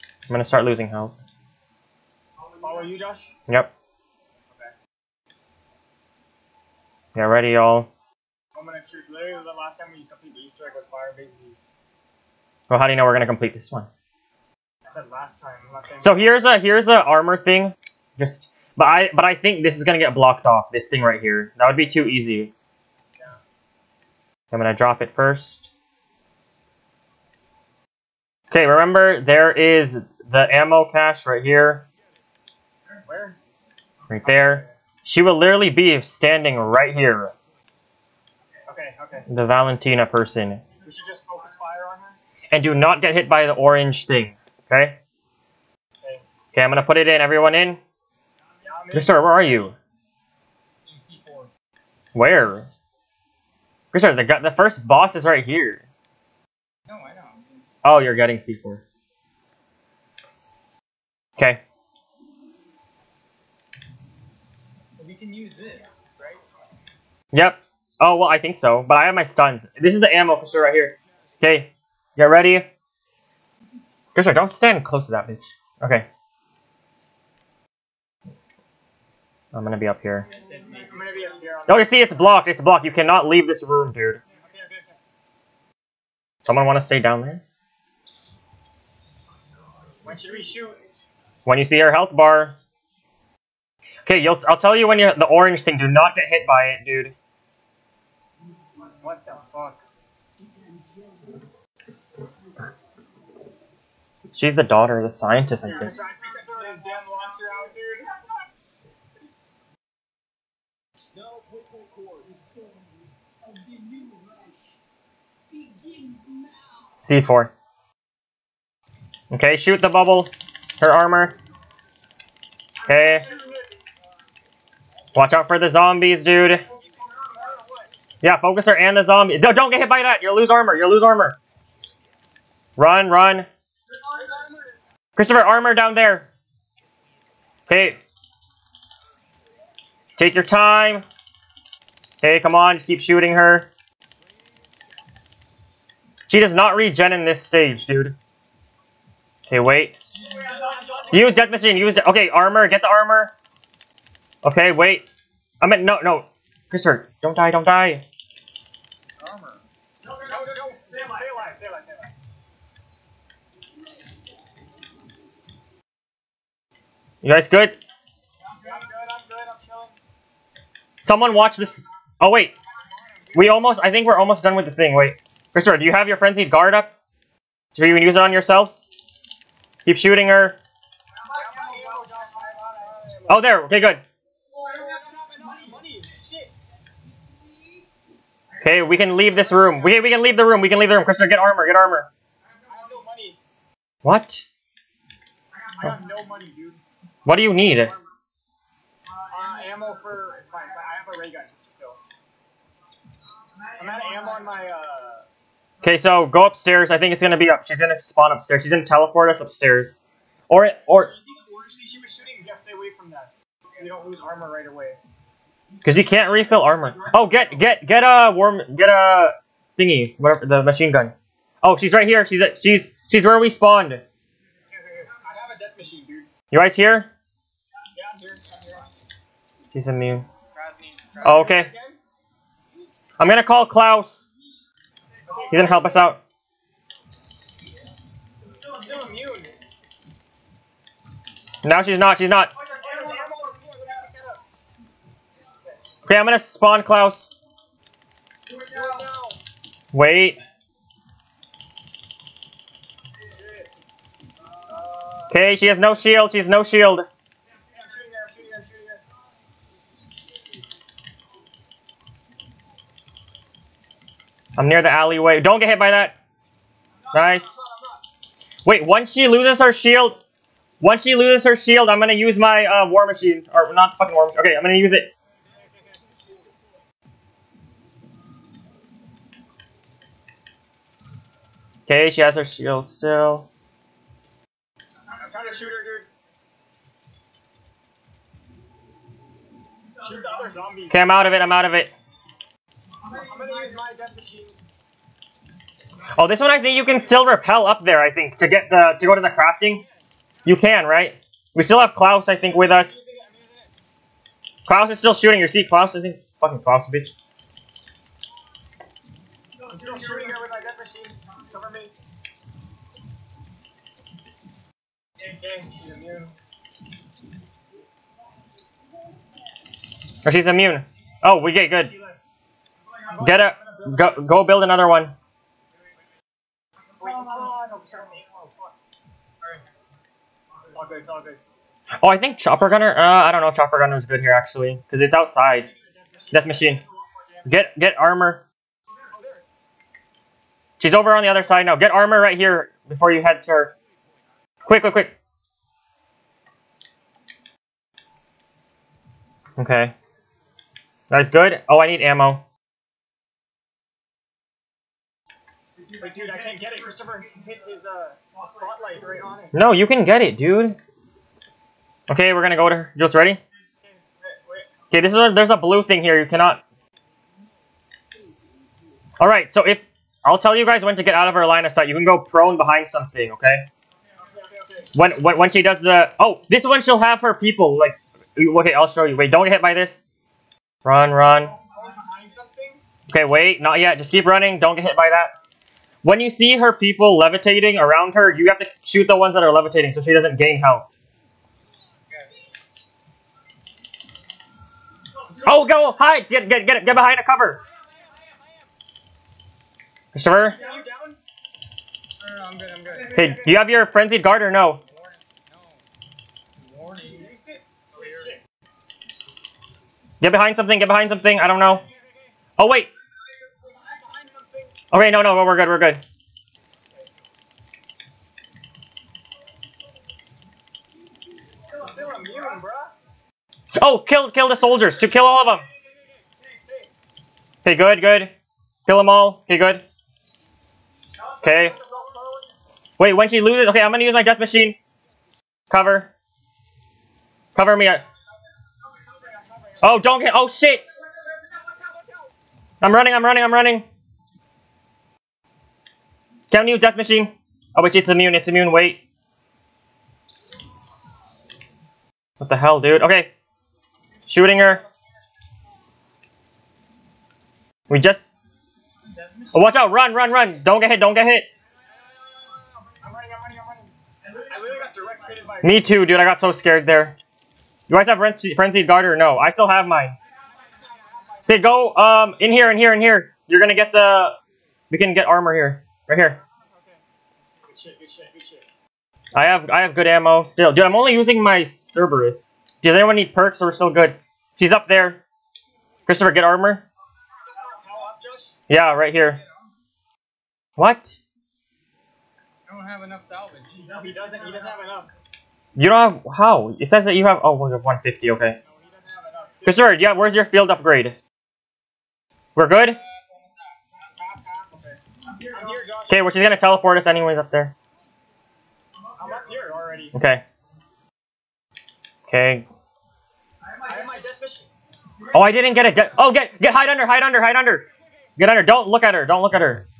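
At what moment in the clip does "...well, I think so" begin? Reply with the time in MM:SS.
01:08.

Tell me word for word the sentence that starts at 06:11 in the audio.
You can go prone behind something, okay?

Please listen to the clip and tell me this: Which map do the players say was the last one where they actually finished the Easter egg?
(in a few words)
Firebase Z.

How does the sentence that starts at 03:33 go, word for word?
you don't lose armor right away.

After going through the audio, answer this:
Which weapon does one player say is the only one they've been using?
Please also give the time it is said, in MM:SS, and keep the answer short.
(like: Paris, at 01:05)
Cerberus, at 08:01.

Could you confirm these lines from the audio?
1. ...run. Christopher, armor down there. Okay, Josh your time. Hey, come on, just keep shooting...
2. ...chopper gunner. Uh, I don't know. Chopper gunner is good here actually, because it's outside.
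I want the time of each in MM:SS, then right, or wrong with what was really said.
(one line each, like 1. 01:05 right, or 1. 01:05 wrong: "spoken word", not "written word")
1. 02:13 wrong: "Take", not "Josh"
2. 05:32 right.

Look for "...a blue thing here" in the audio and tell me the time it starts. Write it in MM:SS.
06:05.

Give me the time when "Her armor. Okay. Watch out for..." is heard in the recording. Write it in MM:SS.
02:00.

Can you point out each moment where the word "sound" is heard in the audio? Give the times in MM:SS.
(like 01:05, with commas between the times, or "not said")
not said.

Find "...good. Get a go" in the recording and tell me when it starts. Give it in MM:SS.
05:21.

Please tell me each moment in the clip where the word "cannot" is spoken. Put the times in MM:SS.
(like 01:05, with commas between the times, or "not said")
01:22, 06:06.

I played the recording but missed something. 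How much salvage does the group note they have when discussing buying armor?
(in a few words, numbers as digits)
150.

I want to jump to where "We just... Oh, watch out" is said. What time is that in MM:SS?
07:37.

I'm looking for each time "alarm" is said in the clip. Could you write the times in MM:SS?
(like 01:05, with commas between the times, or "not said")
not said.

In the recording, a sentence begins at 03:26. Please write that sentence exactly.
I think it's gonna be up.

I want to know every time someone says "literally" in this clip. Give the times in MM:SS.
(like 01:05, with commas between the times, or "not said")
00:09, 00:35.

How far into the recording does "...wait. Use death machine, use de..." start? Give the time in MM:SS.
02:29.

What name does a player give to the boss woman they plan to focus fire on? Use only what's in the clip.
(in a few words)
Valentina.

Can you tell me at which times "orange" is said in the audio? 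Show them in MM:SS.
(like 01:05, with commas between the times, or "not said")
00:43, 01:35.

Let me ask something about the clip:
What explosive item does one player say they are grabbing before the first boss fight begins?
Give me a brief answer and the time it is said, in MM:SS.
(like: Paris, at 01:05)
C4, at 00:50.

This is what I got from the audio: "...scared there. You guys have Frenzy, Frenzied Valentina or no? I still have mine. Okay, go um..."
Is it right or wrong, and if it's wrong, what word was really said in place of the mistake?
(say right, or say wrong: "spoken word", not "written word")
wrong: "Guard", not "Valentina".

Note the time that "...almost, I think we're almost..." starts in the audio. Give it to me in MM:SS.
02:53.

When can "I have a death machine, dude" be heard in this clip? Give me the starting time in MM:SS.
03:43.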